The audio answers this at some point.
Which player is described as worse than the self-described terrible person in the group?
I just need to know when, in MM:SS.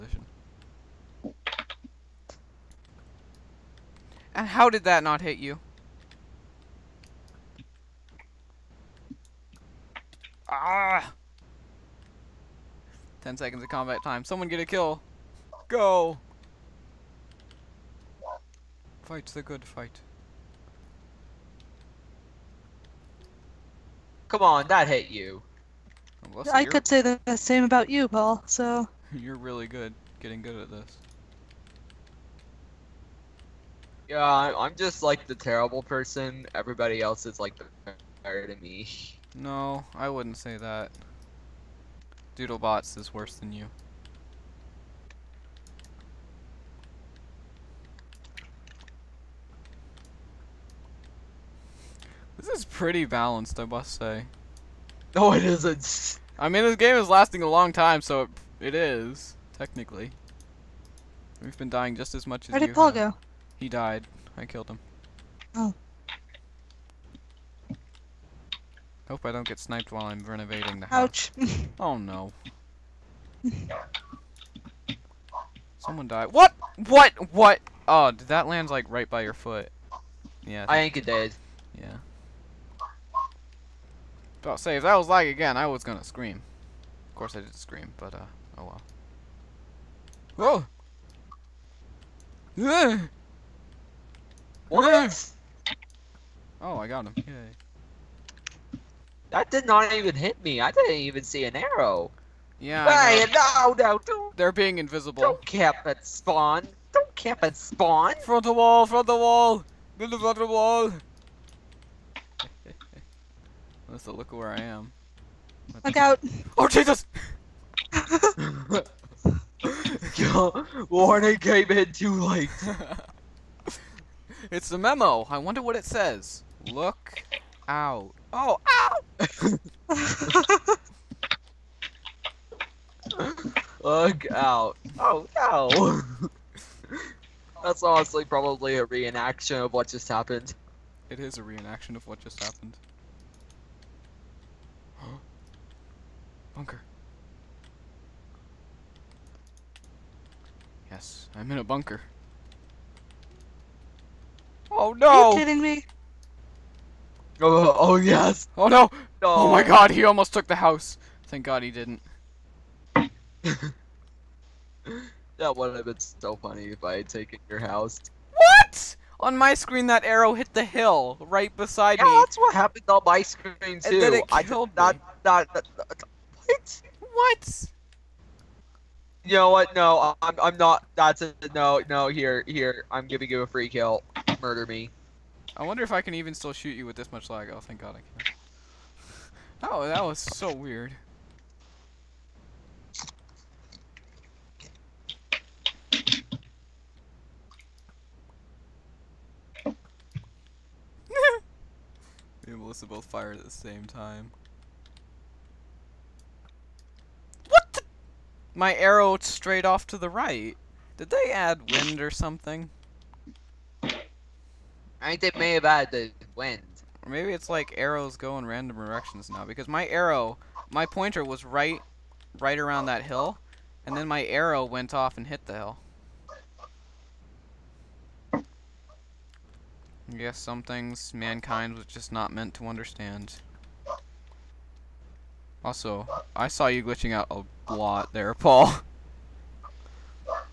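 00:42.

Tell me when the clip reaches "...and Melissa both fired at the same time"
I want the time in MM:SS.
03:22.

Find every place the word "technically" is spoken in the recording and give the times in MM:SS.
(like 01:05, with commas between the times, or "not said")
00:59.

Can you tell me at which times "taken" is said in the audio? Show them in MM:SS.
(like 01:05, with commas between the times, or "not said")
02:47.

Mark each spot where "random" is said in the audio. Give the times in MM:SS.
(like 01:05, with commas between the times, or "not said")
03:38.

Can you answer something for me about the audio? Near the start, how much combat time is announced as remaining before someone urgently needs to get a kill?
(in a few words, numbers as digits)
10 seconds.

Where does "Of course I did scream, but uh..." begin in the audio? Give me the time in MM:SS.
01:27.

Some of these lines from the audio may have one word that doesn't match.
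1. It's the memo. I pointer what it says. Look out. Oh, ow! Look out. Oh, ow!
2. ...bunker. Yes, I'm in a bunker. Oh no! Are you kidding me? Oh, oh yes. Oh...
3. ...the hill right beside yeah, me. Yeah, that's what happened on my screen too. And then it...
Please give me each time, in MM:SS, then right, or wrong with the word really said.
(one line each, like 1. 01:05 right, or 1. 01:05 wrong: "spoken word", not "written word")
1. 02:04 wrong: "wonder", not "pointer"
2. 02:26 right
3. 02:50 right.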